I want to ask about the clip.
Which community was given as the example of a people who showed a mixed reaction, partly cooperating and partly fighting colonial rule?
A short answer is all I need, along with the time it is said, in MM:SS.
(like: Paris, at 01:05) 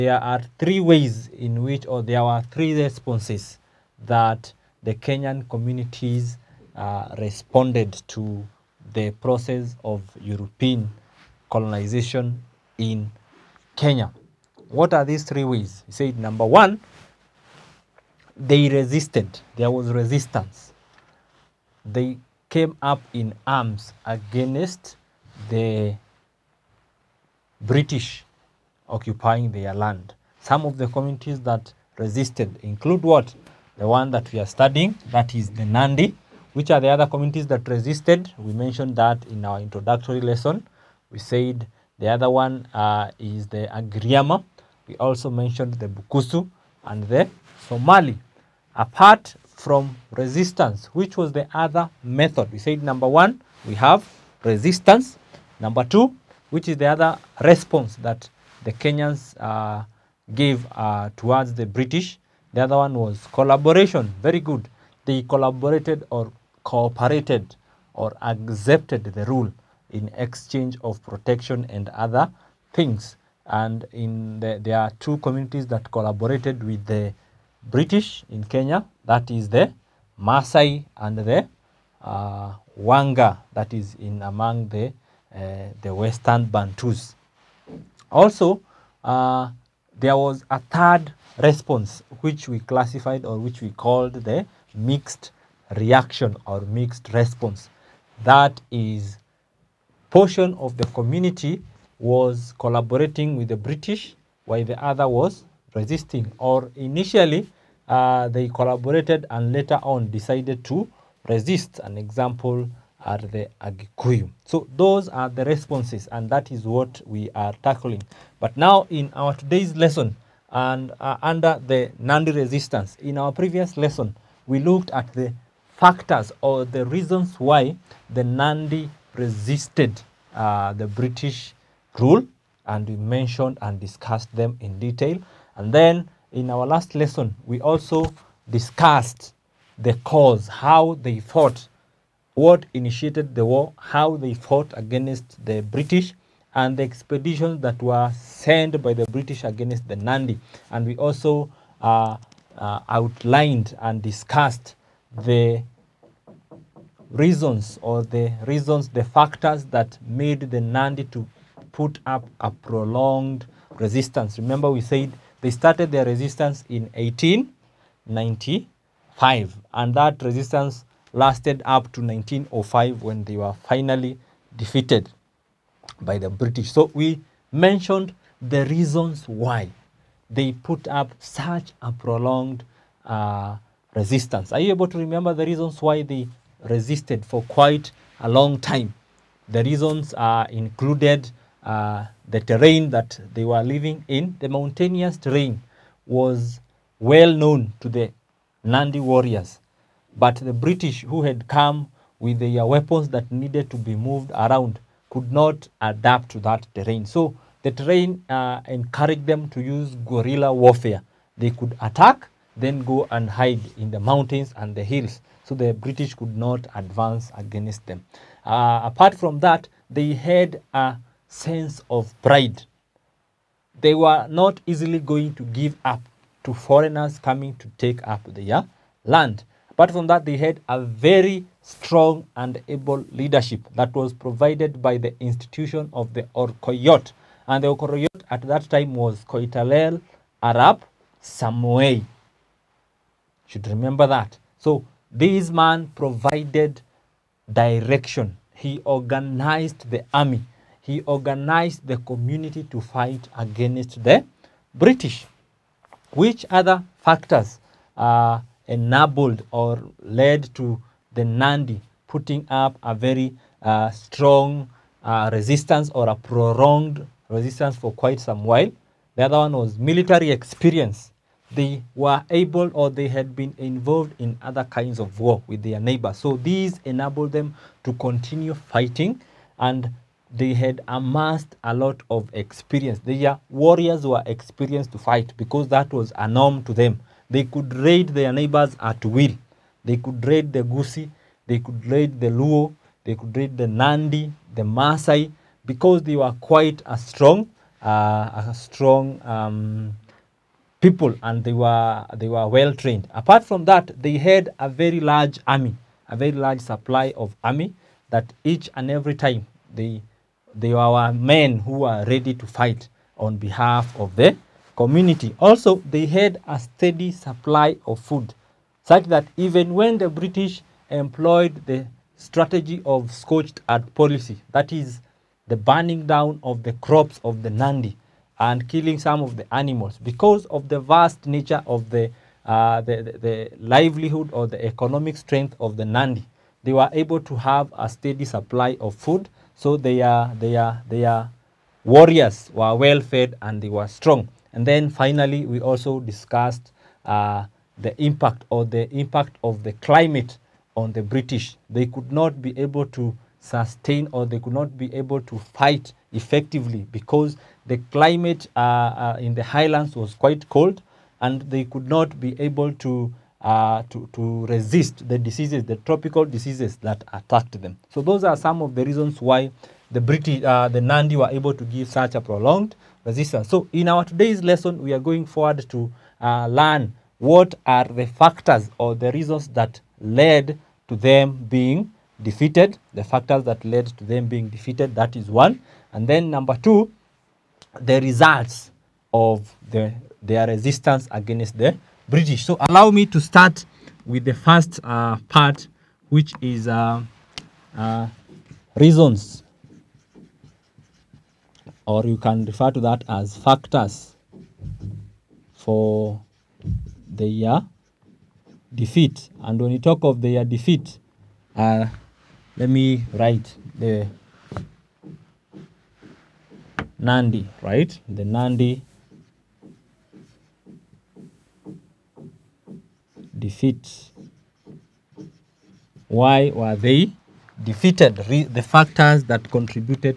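Agikuyu, at 01:53.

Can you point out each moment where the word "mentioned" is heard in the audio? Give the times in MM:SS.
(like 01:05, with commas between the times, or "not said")
00:38, 00:45, 02:12, 02:57.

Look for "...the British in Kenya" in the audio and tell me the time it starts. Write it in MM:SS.
01:16.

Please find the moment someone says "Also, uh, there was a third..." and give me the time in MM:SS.
01:28.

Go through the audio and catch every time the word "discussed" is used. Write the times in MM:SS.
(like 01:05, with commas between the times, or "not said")
02:13, 02:18, 02:34, 05:46.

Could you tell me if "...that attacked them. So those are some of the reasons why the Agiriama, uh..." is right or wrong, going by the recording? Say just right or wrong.
wrong.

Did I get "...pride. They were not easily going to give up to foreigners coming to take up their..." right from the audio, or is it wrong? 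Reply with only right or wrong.
right.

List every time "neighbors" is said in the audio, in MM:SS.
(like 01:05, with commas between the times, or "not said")
04:35, 04:48.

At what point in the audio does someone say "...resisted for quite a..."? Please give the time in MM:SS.
03:06.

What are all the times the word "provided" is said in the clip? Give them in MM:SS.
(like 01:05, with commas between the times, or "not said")
03:54, 04:05.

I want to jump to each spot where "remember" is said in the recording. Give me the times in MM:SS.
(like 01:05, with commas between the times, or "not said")
02:44, 03:04, 04:03.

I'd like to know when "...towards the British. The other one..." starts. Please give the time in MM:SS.
01:01.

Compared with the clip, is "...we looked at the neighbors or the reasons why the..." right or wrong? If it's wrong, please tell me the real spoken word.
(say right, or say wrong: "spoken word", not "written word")
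wrong: "factors", not "neighbors".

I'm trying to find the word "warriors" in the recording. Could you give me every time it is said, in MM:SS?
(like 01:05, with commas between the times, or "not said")
03:19, 04:43, 05:41.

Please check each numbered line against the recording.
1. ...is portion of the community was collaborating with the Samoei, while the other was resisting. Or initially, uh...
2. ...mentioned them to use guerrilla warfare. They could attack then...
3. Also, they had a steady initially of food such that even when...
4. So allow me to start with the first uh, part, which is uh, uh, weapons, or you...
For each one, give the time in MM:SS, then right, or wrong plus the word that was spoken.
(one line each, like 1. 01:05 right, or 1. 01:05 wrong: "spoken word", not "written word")
1. 01:38 wrong: "British", not "Samoei"
2. 03:28 wrong: "encouraged", not "mentioned"
3. 05:15 wrong: "supply", not "initially"
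4. 06:32 wrong: "reasons", not "weapons".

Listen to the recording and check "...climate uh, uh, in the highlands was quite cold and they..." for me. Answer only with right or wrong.
right.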